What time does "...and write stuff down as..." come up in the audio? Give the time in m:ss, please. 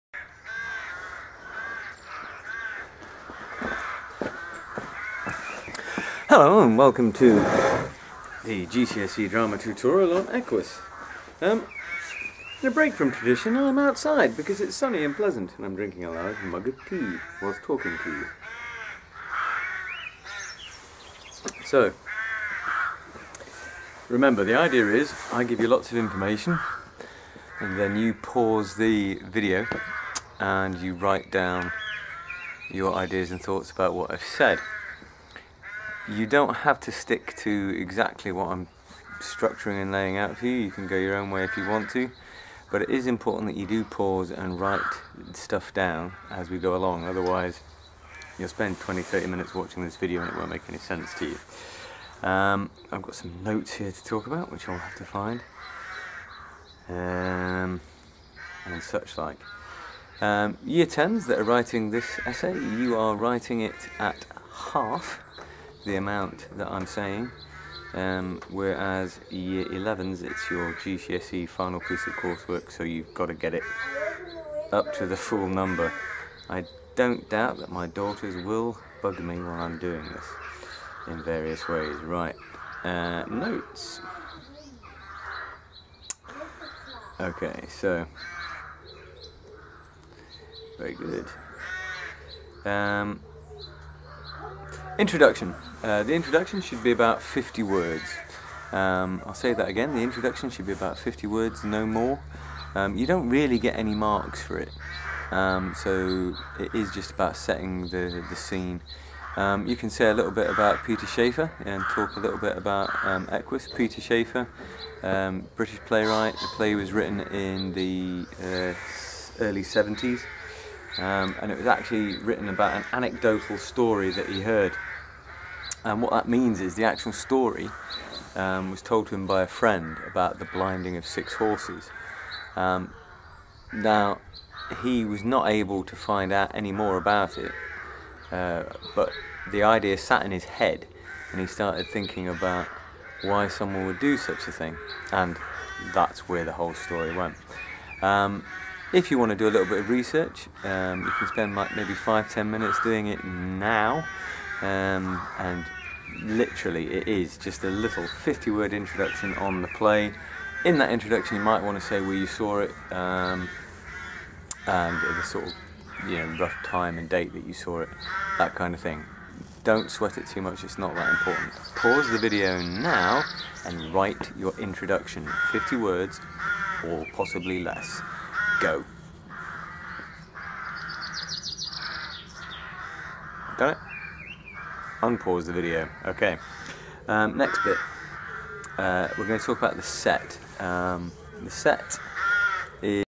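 0:44.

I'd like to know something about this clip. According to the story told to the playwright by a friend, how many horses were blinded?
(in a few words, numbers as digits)
6.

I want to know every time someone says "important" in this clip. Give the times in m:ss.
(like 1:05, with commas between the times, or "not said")
0:43, 2:51.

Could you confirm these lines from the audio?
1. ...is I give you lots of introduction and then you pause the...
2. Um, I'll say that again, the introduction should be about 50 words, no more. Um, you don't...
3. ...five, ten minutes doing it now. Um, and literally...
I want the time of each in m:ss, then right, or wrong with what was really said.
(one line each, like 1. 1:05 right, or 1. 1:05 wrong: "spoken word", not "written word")
1. 0:24 wrong: "information", not "introduction"
2. 1:38 right
3. 2:31 right.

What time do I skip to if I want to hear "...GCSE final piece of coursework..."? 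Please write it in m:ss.
1:10.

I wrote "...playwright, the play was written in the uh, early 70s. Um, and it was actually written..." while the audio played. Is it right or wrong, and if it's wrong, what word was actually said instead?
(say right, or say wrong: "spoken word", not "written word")
right.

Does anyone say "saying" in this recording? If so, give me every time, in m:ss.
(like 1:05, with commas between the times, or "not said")
1:06.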